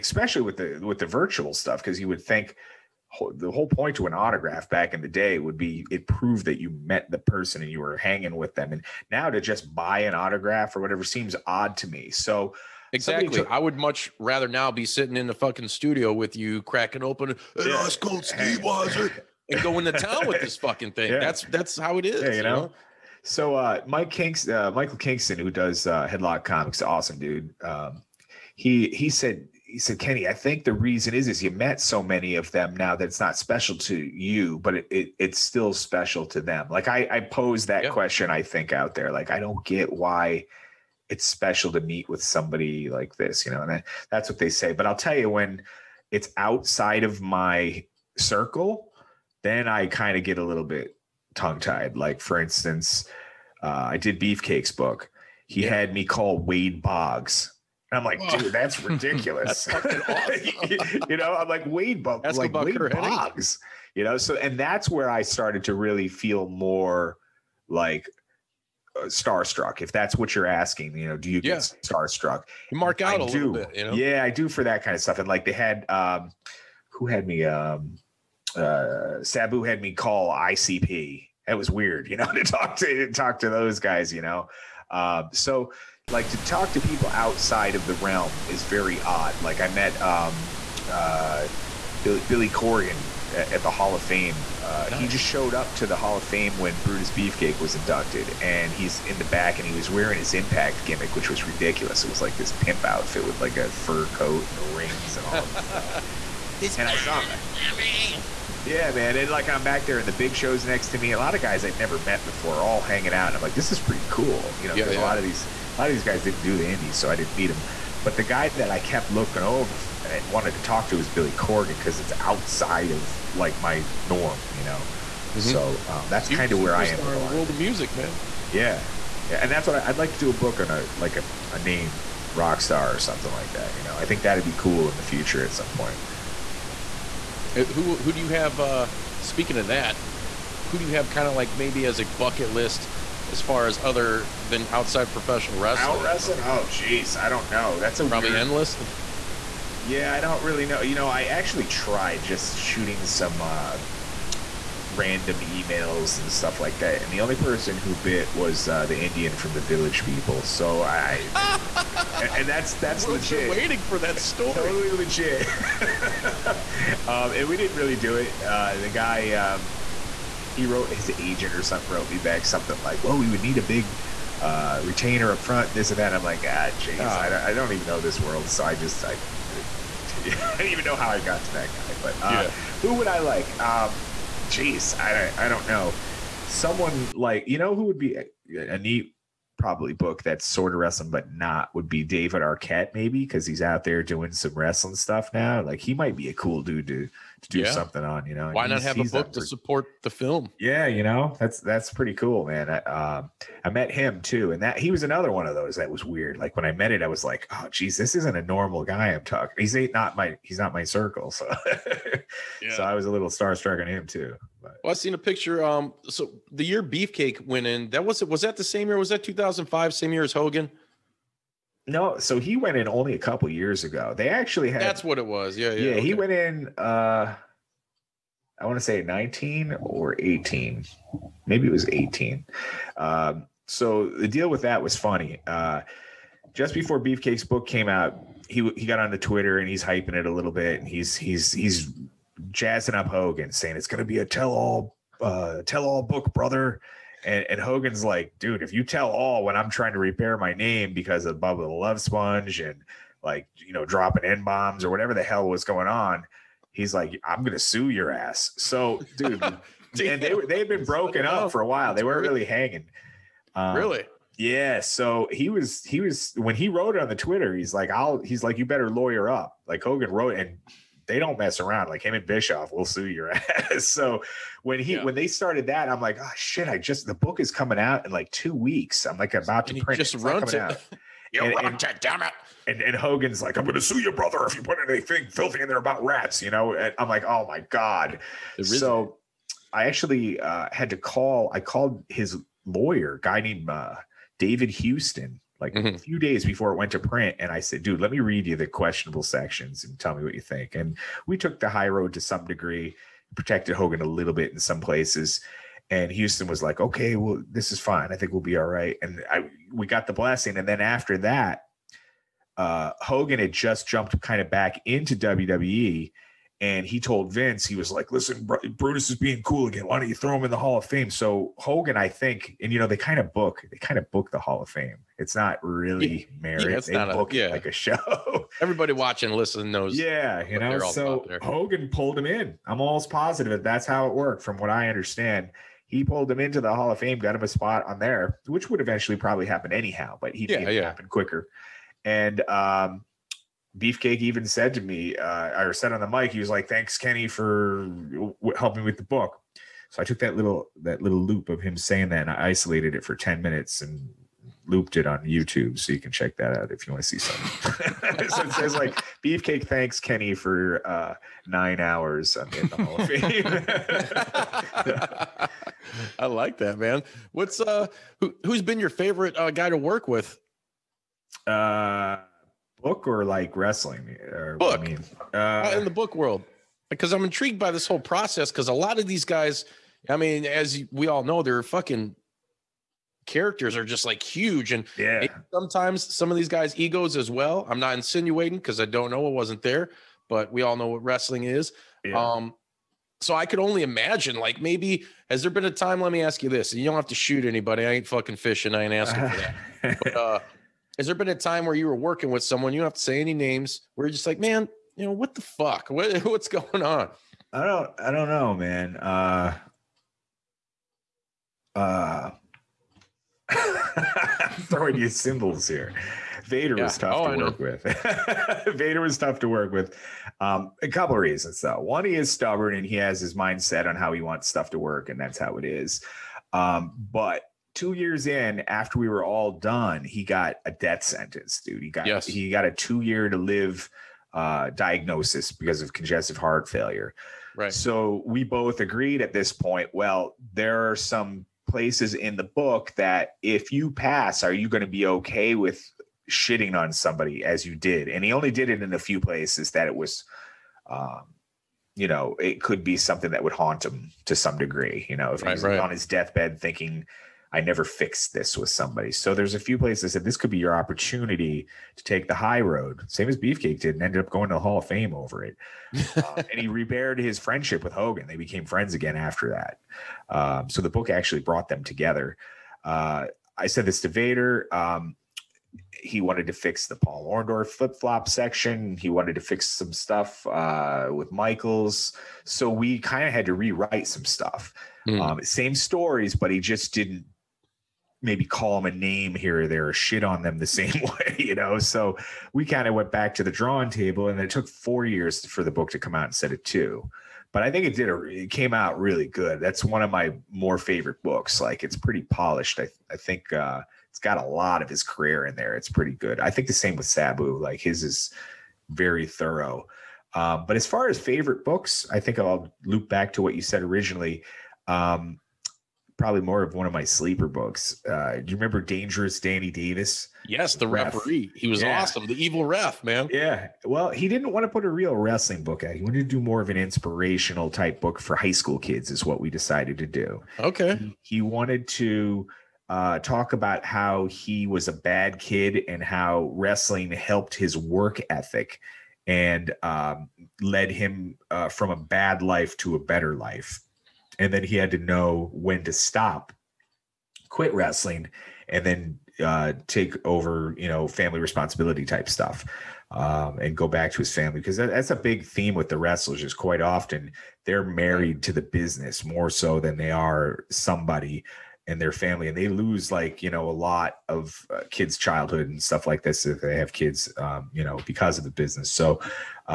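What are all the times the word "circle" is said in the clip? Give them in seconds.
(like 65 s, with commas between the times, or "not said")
48 s, 210 s.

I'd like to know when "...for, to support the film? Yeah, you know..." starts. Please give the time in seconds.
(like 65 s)
199 s.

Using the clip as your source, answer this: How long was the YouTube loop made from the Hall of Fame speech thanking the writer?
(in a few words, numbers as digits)
10 minutes.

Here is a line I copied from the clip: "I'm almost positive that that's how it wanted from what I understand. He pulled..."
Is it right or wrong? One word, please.
wrong.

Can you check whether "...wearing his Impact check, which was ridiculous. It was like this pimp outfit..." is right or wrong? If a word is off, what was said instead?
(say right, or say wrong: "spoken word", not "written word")
wrong: "gimmick", not "check".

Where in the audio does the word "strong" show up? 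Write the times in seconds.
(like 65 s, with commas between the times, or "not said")
not said.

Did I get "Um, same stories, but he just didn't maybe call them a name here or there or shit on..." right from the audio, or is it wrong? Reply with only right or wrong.
right.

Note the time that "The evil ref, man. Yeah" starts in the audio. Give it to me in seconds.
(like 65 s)
522 s.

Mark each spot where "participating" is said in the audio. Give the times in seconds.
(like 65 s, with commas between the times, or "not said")
not said.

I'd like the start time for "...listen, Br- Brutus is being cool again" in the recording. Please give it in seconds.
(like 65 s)
318 s.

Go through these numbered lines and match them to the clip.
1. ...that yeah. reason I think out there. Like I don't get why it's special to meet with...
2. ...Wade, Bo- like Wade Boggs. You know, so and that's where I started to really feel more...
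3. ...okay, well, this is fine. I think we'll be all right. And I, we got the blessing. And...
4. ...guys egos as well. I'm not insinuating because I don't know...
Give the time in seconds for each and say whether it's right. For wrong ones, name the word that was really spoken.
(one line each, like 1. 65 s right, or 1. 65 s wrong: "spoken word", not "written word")
1. 37 s wrong: "question", not "reason"
2. 61 s right
3. 306 s right
4. 386 s right.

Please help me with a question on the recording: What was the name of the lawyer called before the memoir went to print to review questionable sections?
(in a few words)
David Houston.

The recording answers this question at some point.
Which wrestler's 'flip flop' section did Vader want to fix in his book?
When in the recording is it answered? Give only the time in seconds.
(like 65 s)
476 s.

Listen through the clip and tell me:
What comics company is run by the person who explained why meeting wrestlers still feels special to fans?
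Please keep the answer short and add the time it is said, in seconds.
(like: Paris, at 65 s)
Headlock Comics, at 26 s.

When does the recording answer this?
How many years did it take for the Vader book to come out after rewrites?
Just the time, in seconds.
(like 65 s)
494 s.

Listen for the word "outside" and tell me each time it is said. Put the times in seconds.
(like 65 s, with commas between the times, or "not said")
46 s, 87 s, 122 s, 144 s.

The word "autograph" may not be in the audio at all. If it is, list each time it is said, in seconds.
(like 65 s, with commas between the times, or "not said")
4 s, 10 s.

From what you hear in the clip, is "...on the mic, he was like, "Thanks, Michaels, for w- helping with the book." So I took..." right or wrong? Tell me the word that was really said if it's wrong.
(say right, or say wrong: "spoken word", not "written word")
wrong: "Kenny", not "Michaels".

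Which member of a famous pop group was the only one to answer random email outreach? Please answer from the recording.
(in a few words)
The Indian.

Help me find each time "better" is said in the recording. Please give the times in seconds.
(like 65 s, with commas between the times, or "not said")
268 s, 542 s.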